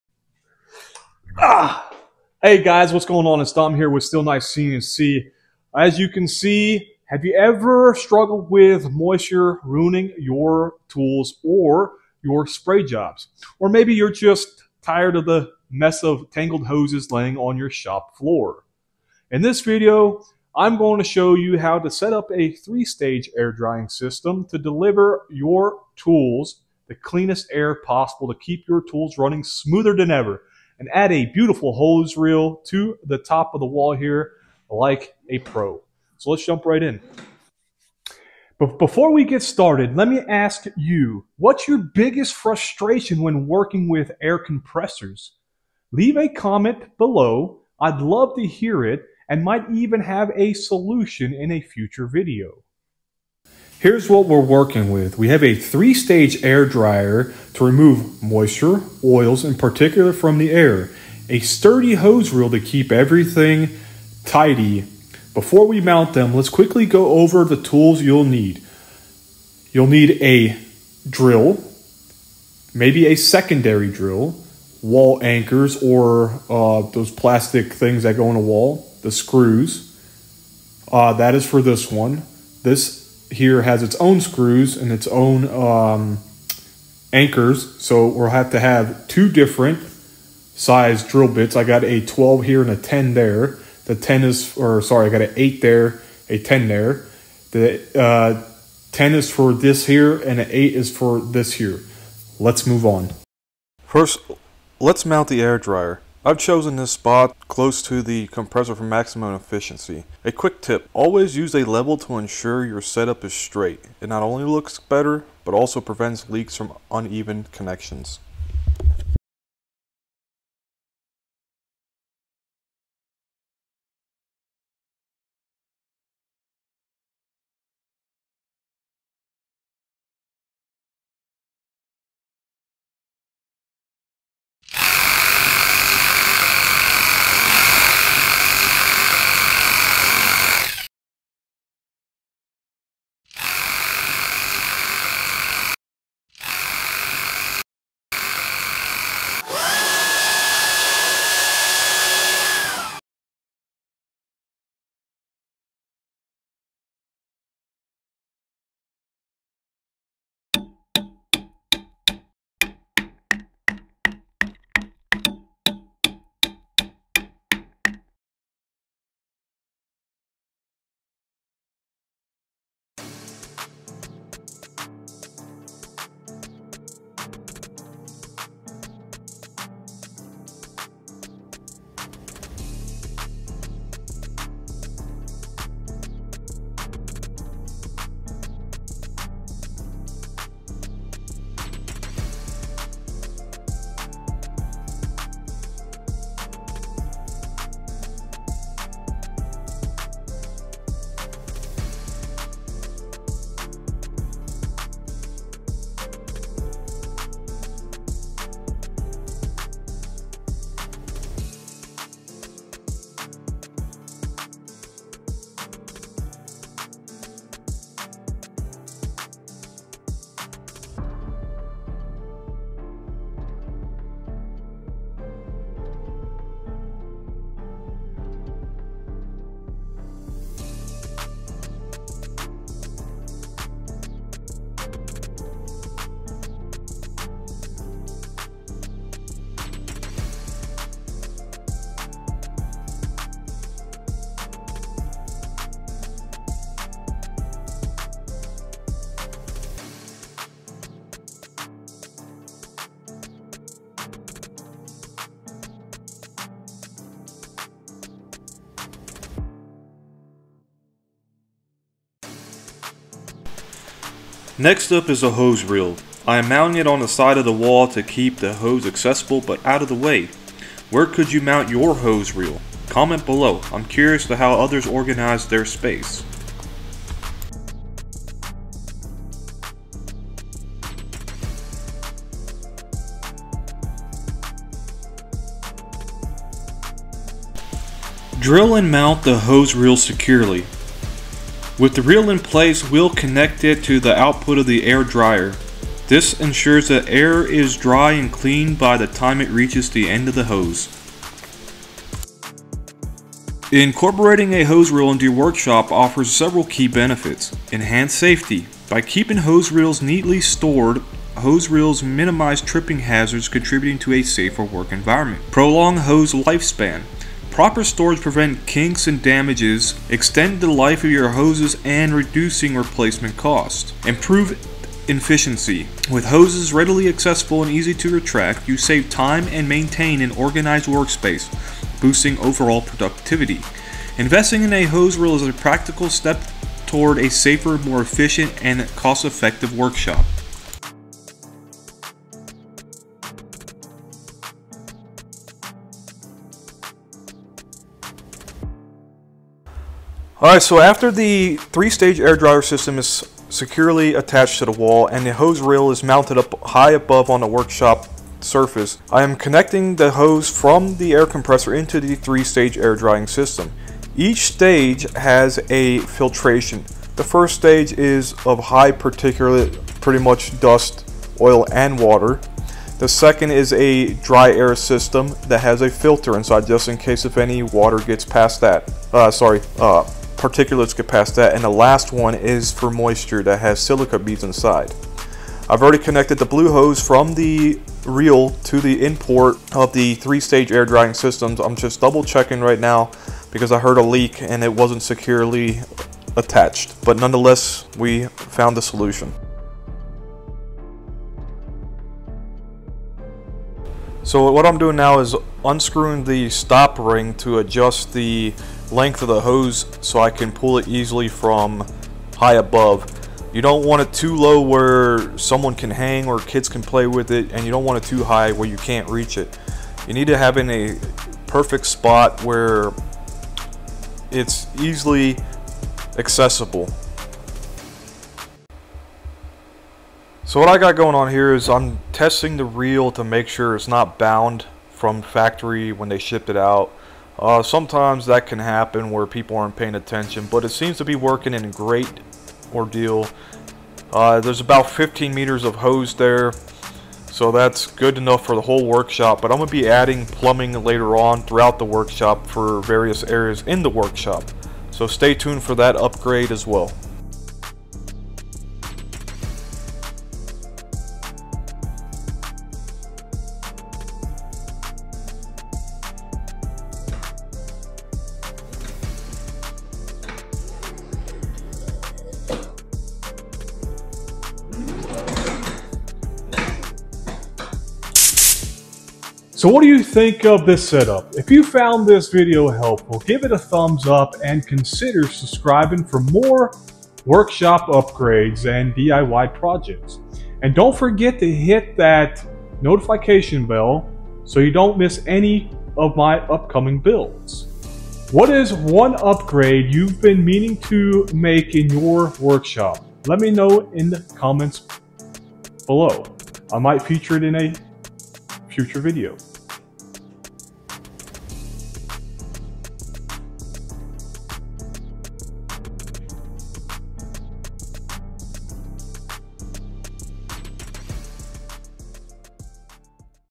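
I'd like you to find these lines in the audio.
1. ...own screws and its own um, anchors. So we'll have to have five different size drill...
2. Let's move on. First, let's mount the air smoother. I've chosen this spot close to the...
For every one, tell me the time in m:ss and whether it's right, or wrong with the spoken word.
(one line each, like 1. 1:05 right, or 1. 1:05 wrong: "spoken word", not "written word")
1. 1:23 wrong: "two", not "five"
2. 1:42 wrong: "dryer", not "smoother".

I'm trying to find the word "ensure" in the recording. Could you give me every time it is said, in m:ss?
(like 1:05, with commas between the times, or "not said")
1:52, 4:56.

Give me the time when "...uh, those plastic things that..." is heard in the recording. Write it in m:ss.
1:16.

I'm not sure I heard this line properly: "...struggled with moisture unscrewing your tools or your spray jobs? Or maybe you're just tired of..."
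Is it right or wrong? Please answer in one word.
wrong.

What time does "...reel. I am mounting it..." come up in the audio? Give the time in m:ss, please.
4:25.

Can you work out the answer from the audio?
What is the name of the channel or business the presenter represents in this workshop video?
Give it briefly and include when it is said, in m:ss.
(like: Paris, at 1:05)
SteelKnight CNC, at 0:04.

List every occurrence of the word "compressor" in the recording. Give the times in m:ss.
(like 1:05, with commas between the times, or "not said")
0:44, 1:48, 6:01.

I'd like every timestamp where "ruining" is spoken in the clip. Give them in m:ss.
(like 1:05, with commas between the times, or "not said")
0:09.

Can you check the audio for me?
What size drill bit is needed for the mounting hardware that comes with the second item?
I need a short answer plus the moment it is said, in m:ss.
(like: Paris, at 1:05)
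8, at 1:35.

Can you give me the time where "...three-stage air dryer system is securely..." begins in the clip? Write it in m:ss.
5:51.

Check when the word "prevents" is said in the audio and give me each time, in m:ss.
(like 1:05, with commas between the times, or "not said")
1:55, 5:18.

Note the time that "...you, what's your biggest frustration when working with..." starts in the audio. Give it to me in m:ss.
0:40.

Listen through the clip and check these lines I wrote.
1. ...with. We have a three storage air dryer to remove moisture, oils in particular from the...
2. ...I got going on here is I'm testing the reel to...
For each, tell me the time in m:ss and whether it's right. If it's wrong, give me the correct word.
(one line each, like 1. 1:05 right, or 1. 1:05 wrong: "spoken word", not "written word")
1. 0:54 wrong: "stage", not "storage"
2. 7:10 right.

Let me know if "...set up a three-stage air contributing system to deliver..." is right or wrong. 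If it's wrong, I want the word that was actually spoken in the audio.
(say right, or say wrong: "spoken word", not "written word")
wrong: "drying", not "contributing".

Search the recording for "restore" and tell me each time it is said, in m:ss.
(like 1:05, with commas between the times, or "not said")
not said.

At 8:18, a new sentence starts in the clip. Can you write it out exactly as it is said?
What is one upgrade you've been meaning to make in your workshop?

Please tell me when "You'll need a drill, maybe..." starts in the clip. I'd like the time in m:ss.
1:09.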